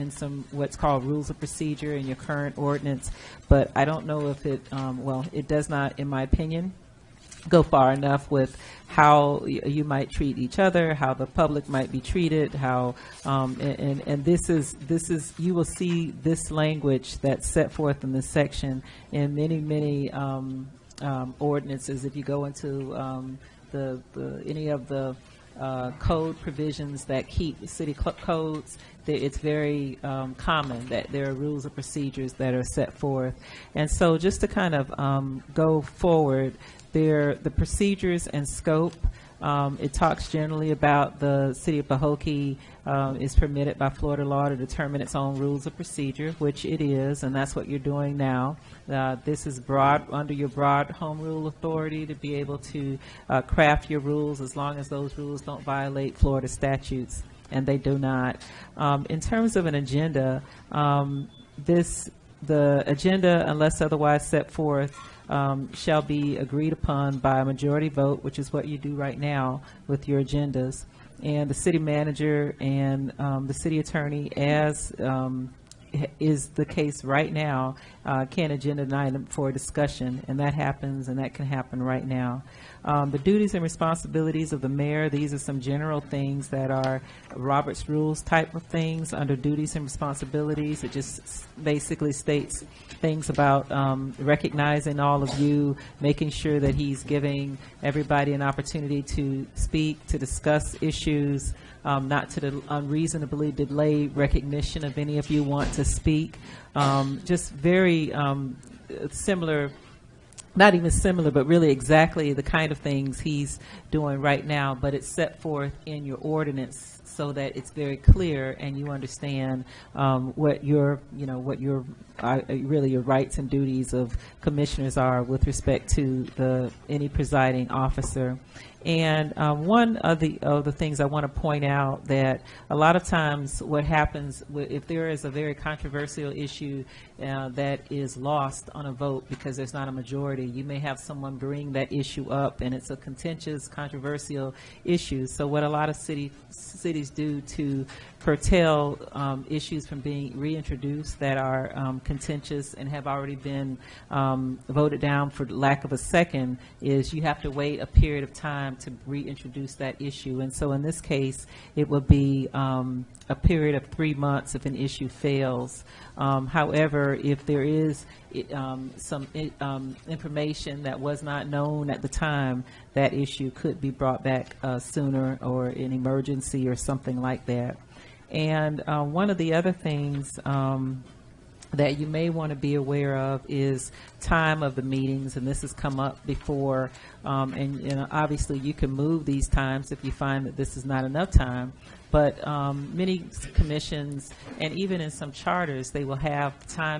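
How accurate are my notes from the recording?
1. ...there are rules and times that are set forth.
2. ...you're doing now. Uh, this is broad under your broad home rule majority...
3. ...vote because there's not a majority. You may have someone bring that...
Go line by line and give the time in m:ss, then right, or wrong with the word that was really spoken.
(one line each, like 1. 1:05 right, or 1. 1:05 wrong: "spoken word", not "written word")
1. 0:31 wrong: "procedures", not "times"
2. 0:47 wrong: "authority", not "majority"
3. 2:18 right.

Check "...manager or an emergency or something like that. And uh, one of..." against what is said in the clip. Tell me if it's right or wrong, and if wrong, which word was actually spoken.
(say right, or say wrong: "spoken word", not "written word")
wrong: "sooner", not "manager".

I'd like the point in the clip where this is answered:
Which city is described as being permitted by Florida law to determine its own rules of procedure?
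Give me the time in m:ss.
0:41.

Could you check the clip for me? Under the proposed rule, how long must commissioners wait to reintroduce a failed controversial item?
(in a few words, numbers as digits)
3 months.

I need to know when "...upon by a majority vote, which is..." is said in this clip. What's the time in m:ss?
1:06.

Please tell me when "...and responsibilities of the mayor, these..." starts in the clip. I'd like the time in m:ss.
1:23.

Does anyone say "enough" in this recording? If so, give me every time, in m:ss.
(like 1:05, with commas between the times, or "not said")
0:07, 3:11.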